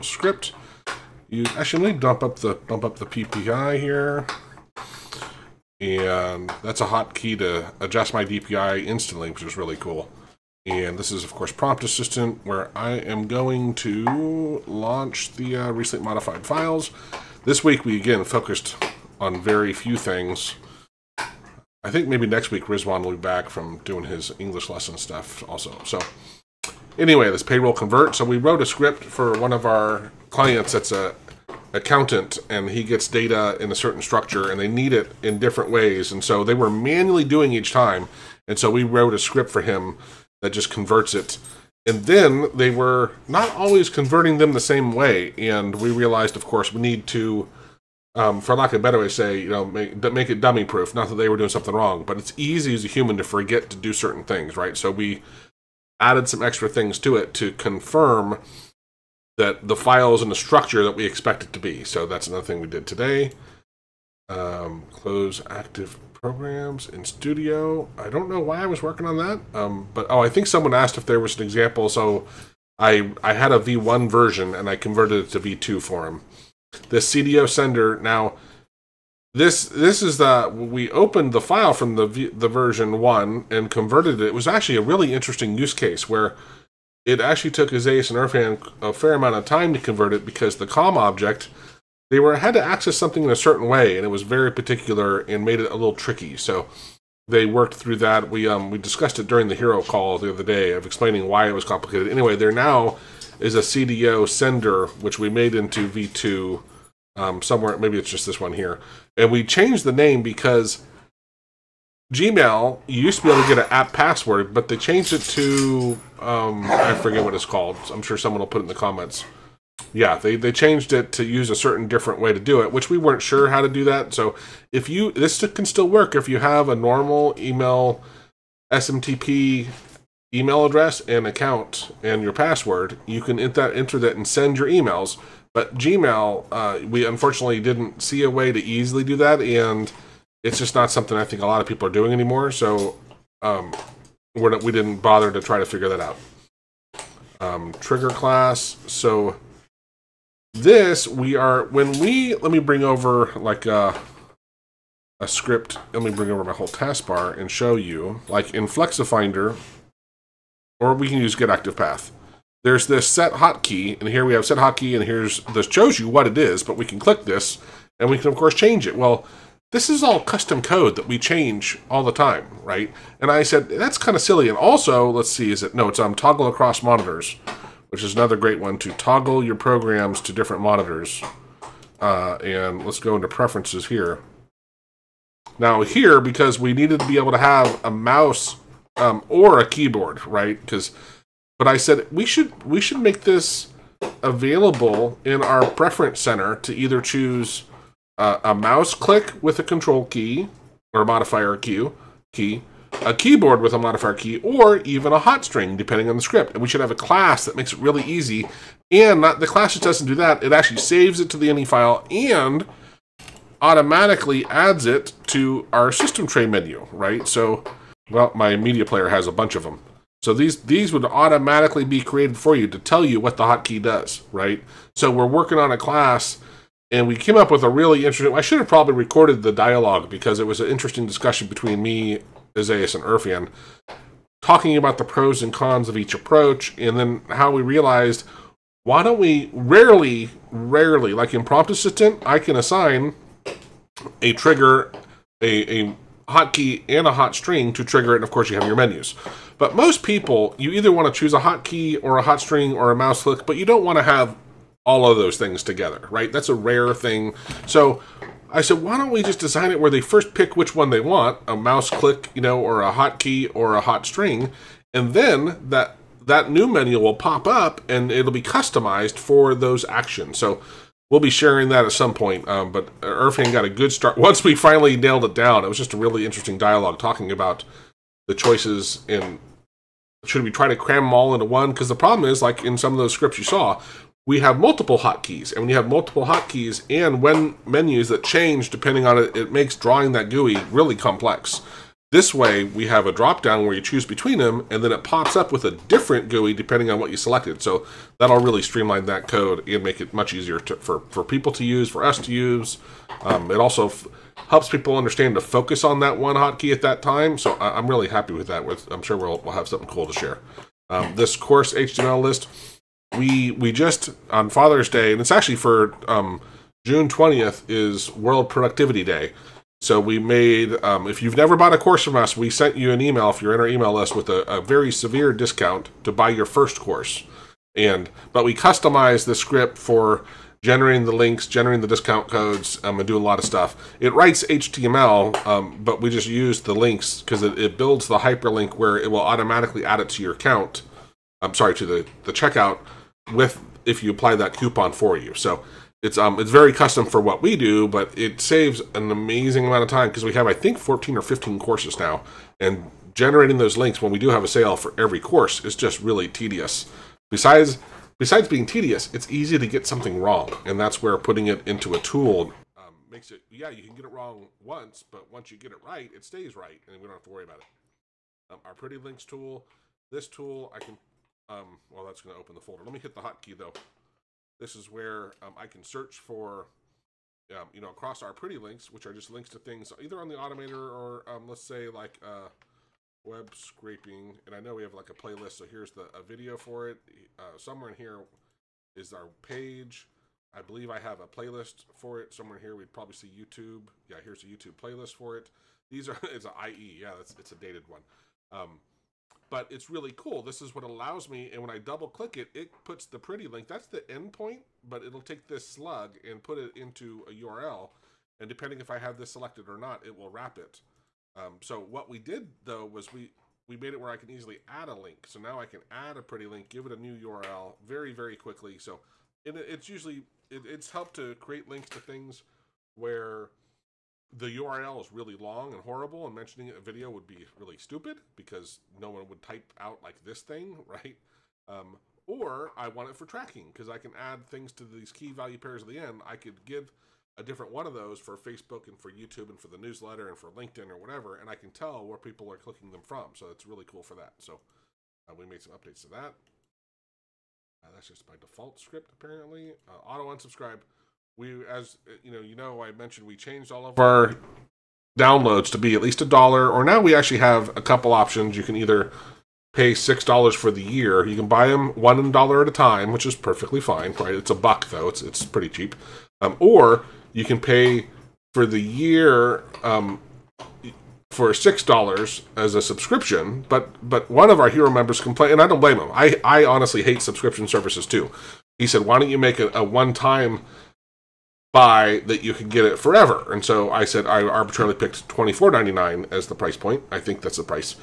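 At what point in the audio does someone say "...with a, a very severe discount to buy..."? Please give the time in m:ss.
5:24.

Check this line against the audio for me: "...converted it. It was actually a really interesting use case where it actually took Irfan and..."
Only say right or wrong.
wrong.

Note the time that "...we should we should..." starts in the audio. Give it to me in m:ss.
3:12.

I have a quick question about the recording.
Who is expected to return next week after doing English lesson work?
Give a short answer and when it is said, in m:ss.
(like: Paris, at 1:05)
Rizwan, at 0:22.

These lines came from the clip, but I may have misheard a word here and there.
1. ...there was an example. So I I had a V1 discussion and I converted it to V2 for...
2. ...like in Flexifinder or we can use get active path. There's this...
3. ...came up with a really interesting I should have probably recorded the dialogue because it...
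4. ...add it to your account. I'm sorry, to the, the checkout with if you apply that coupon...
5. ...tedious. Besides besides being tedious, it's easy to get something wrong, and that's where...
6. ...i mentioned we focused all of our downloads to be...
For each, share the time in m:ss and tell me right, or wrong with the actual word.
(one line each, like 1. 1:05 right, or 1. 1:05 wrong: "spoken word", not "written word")
1. 1:11 wrong: "version", not "discussion"
2. 2:38 right
3. 3:47 right
4. 5:39 right
5. 5:56 right
6. 7:32 wrong: "changed", not "focused".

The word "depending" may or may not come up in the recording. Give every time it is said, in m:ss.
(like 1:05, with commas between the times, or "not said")
3:25, 4:48, 4:56, 6:48.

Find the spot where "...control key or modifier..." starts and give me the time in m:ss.
3:19.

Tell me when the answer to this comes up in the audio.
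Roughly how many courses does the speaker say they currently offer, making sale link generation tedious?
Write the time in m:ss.
5:50.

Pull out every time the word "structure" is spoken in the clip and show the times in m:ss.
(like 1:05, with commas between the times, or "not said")
0:34, 1:00.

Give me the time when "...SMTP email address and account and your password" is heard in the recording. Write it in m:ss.
2:08.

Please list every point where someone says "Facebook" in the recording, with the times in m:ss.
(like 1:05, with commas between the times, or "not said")
7:18.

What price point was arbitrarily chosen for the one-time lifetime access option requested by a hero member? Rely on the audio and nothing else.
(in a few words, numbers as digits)
$24.99.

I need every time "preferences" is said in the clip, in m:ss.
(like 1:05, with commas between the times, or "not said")
3:03, 3:15.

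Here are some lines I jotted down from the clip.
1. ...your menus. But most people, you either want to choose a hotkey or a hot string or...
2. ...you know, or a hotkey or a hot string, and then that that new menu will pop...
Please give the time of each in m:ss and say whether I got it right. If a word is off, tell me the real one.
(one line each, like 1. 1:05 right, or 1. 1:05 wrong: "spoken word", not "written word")
1. 4:08 right
2. 4:22 right.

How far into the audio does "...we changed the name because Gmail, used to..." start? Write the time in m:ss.
1:49.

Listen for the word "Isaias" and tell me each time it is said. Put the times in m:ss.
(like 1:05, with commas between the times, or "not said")
1:27, 3:52.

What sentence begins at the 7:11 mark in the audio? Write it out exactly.
Um, or I want it for tracking because I can add things to these key value pairs at the end.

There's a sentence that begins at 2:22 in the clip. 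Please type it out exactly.
So um, we're not, we didn't bother to try to figure that out.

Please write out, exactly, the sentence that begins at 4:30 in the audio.
So we'll be sharing that at some point.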